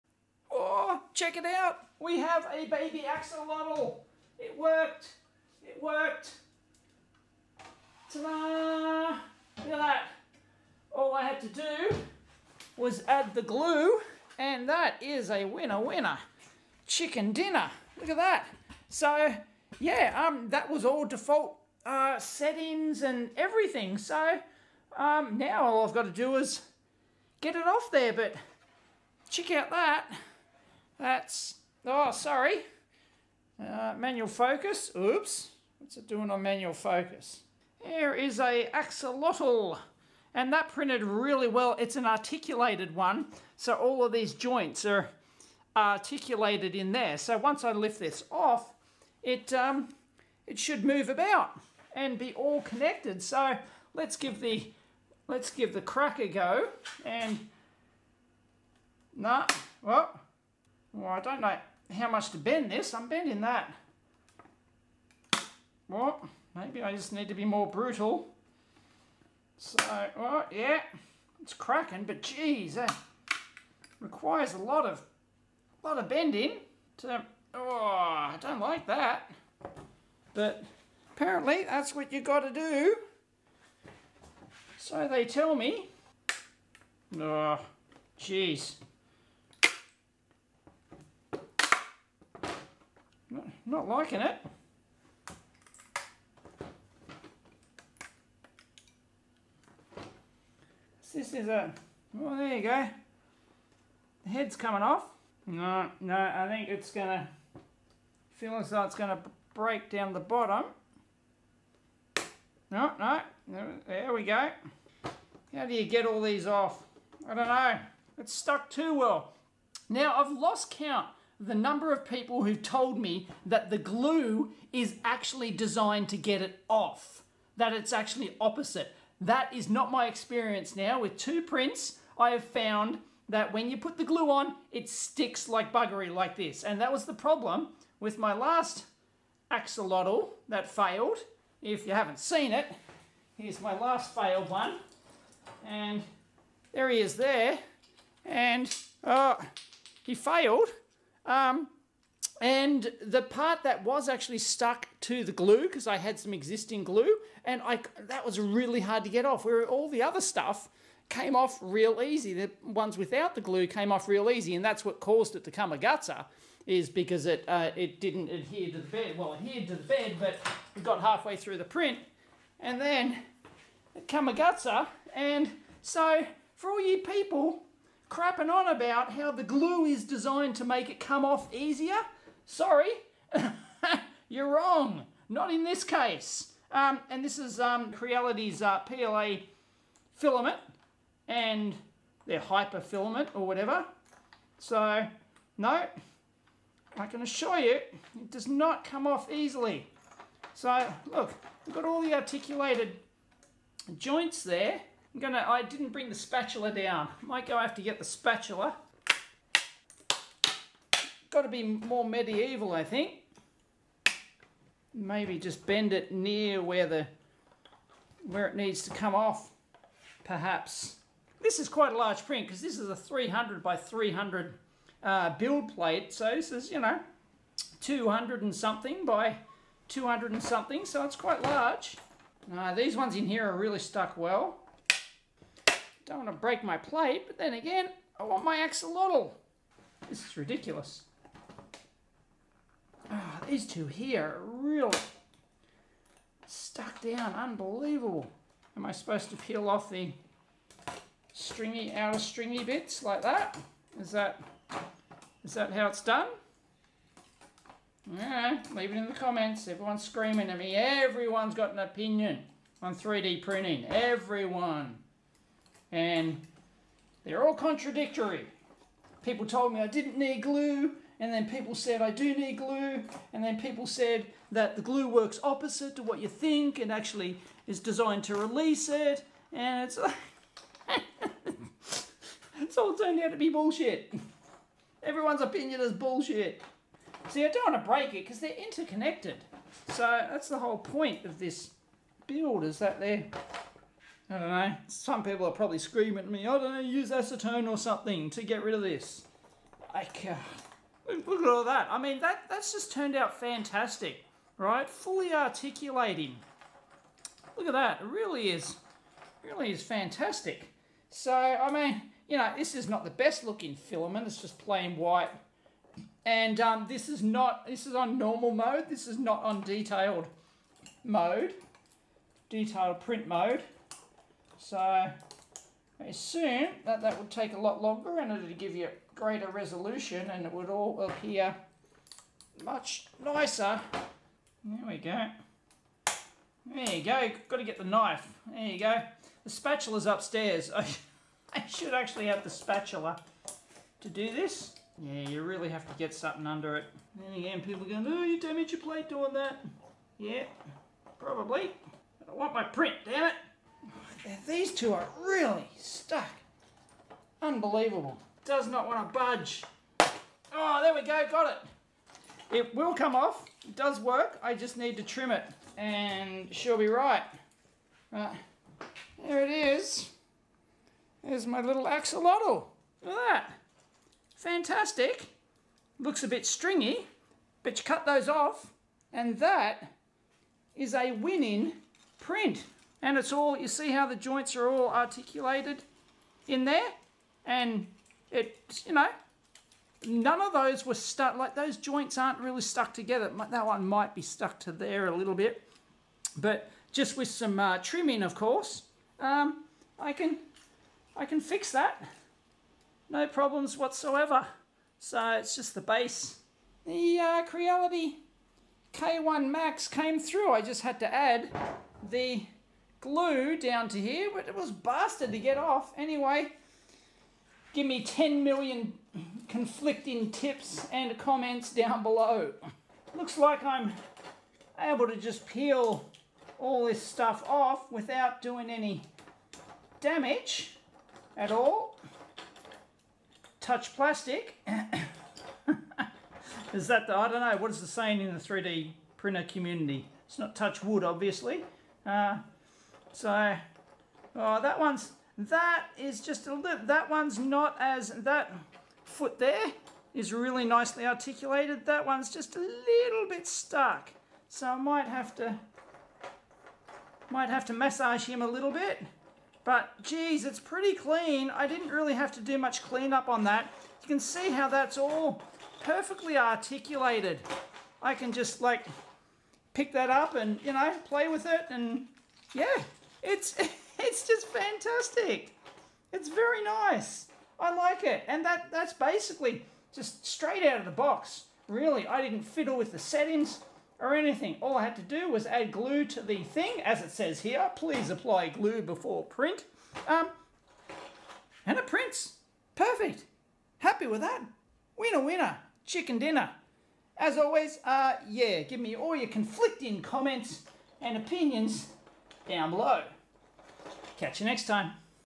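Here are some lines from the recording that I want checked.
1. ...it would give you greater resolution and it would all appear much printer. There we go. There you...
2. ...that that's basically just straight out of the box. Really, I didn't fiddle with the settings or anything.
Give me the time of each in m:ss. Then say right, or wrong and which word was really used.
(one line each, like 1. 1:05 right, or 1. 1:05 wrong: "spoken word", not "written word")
1. 5:28 wrong: "nicer", not "printer"
2. 7:58 right.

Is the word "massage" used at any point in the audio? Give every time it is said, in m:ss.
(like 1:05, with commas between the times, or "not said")
7:37.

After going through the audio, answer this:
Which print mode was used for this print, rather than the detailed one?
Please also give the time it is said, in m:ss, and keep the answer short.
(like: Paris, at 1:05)
Normal mode, at 5:18.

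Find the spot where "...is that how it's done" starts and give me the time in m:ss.
4:15.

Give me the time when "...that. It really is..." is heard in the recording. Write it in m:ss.
5:07.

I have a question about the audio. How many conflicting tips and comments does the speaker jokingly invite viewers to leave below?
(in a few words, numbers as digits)
10 million.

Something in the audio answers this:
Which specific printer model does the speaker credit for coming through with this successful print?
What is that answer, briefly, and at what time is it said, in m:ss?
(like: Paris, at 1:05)
Creality K1 Max, at 6:47.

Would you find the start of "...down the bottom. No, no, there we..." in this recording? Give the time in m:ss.
1:49.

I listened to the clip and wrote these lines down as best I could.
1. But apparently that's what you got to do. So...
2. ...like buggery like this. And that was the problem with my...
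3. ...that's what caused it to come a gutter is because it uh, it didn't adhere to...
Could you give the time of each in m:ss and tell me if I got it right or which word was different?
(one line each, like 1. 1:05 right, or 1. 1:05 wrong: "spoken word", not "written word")
1. 1:20 right
2. 2:15 right
3. 2:44 right.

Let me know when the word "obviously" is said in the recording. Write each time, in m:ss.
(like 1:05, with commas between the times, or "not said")
7:21.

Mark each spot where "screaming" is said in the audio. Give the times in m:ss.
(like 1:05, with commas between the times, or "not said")
4:20, 4:55.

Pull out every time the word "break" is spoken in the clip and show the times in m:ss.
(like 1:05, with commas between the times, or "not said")
1:49, 3:56, 4:47.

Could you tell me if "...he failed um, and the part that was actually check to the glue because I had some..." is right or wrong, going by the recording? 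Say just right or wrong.
wrong.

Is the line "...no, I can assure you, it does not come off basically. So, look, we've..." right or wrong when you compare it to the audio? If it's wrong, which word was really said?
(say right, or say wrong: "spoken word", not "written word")
wrong: "easily", not "basically".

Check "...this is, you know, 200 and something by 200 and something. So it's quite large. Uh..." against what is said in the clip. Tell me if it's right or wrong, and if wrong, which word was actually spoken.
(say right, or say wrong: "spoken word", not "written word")
right.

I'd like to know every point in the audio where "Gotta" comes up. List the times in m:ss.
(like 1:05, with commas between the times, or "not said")
3:31.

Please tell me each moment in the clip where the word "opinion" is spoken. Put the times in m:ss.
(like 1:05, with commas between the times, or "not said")
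4:21, 4:45, 8:21.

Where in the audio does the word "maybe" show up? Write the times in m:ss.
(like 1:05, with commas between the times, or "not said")
1:06, 3:34.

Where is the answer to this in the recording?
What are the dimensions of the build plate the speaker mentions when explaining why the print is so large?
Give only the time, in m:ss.
3:42.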